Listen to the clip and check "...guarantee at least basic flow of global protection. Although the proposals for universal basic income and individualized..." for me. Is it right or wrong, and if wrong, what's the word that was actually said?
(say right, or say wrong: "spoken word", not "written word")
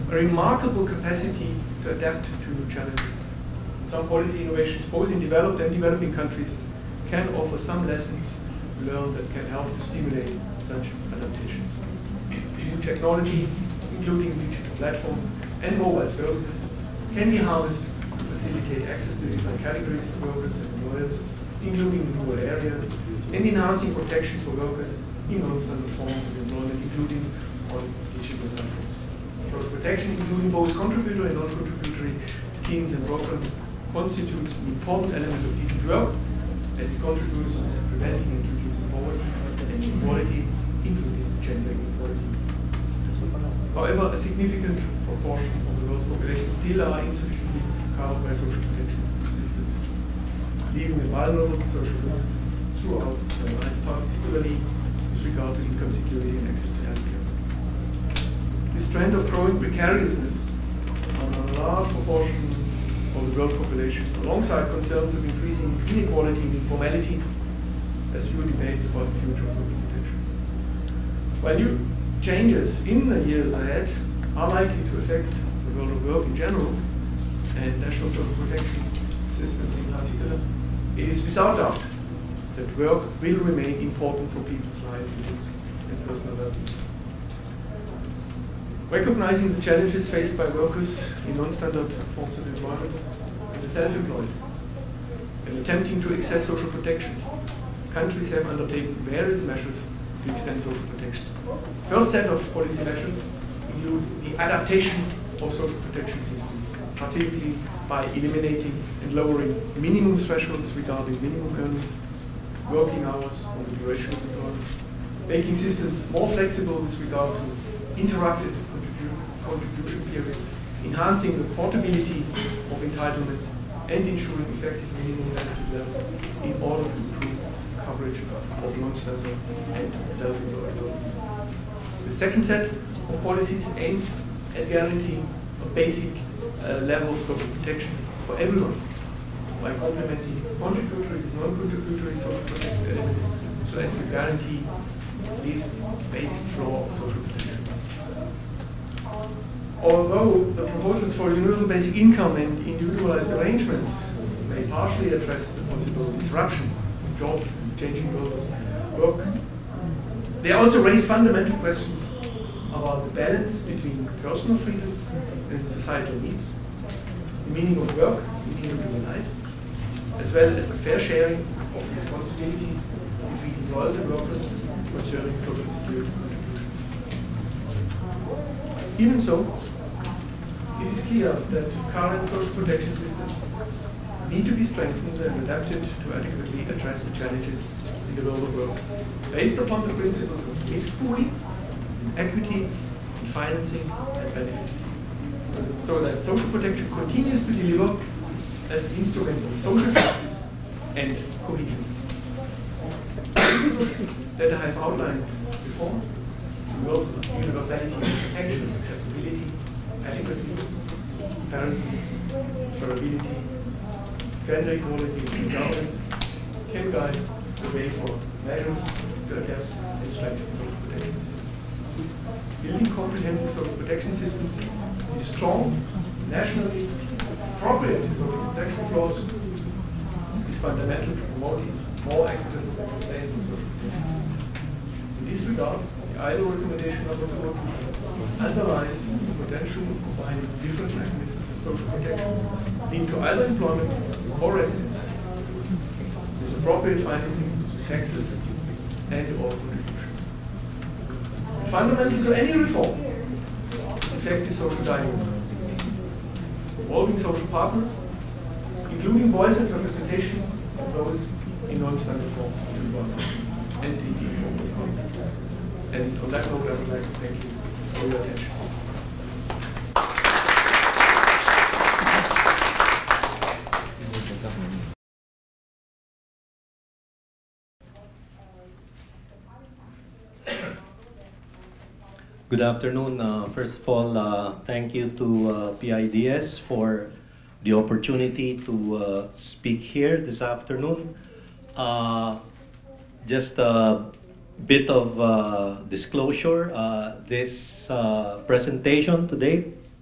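wrong: "social", not "global".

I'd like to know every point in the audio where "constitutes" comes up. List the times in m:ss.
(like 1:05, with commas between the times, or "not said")
0:33.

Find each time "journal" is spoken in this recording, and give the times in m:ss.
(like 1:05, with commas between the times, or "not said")
not said.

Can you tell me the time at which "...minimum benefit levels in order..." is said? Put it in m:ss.
2:04.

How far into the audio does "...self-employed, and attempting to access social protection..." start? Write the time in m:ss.
1:33.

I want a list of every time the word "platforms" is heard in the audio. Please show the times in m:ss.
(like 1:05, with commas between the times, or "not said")
0:14, 0:28.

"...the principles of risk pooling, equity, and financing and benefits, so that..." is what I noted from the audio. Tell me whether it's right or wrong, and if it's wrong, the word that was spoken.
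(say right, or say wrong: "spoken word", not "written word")
right.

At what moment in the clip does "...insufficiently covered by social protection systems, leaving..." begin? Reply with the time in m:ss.
0:46.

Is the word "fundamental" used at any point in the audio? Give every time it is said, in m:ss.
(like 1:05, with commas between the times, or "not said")
2:41, 3:50, 4:11.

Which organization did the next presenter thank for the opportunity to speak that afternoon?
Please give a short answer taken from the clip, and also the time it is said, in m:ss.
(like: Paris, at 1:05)
PIDS, at 4:45.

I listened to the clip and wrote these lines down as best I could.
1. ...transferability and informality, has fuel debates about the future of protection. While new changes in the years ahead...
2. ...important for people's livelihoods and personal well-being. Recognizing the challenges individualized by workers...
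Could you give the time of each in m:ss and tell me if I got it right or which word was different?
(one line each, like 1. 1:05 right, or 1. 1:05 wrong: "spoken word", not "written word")
1. 1:05 wrong: "inequality", not "transferability"
2. 1:23 wrong: "faced", not "individualized".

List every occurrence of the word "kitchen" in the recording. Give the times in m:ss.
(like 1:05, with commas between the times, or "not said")
not said.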